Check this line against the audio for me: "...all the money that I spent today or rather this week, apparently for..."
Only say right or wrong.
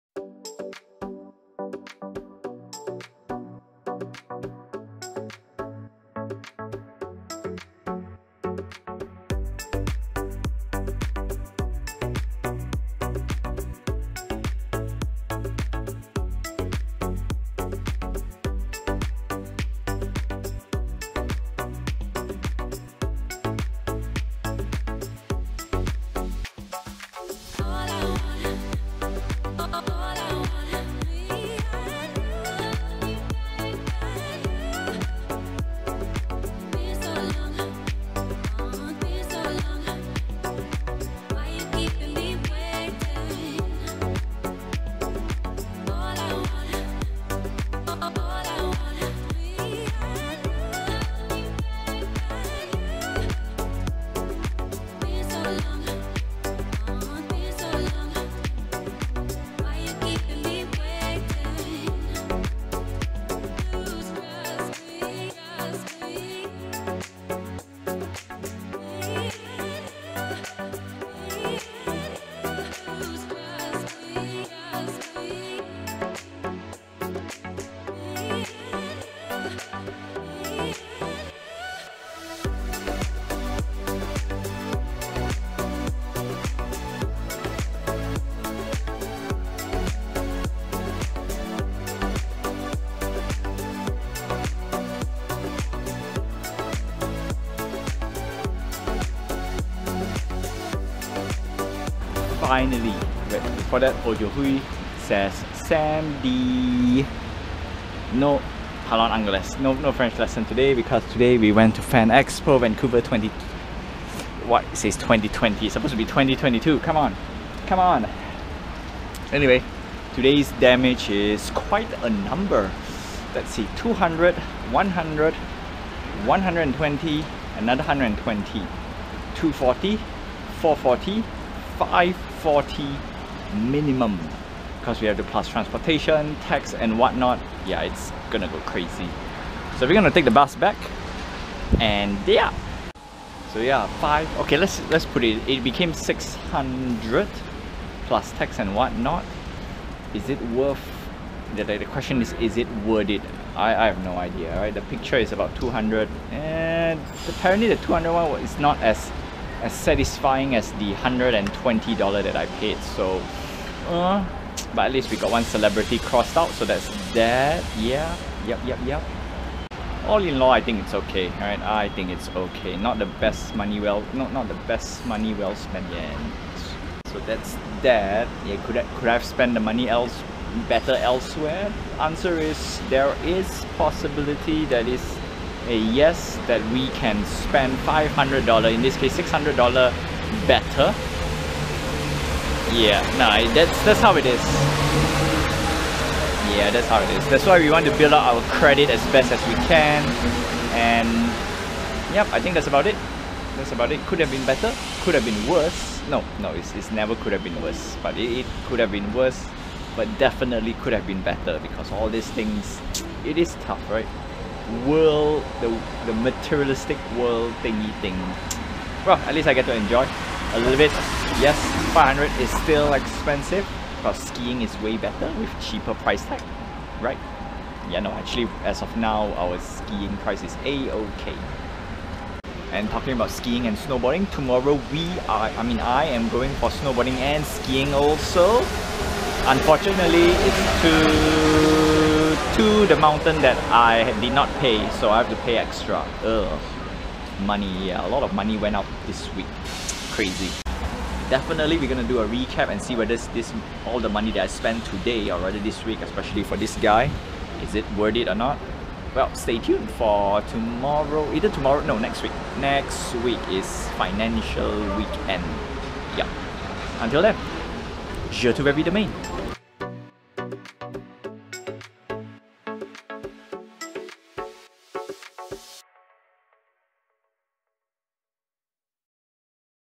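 wrong.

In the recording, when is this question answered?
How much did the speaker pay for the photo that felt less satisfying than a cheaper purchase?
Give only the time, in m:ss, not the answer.
2:34.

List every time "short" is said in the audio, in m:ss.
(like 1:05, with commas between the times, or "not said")
not said.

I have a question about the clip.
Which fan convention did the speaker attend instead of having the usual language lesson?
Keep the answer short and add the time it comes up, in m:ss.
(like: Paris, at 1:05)
Fan Expo Vancouver, at 1:51.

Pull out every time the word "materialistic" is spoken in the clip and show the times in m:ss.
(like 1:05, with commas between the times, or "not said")
3:36.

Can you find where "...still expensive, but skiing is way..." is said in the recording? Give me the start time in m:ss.
3:42.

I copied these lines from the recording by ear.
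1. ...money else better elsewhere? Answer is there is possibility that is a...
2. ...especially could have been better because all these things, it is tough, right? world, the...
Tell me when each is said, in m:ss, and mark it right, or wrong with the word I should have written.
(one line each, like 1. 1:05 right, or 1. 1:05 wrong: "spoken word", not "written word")
1. 2:59 right
2. 3:30 wrong: "definitely", not "especially".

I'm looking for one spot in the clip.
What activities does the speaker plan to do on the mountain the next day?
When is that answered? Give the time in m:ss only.
3:56.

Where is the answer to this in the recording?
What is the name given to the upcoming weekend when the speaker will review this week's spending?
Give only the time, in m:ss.
4:23.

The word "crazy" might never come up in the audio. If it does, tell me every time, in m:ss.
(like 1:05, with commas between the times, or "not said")
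2:18, 4:10.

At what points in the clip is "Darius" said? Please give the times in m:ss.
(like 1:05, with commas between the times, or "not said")
not said.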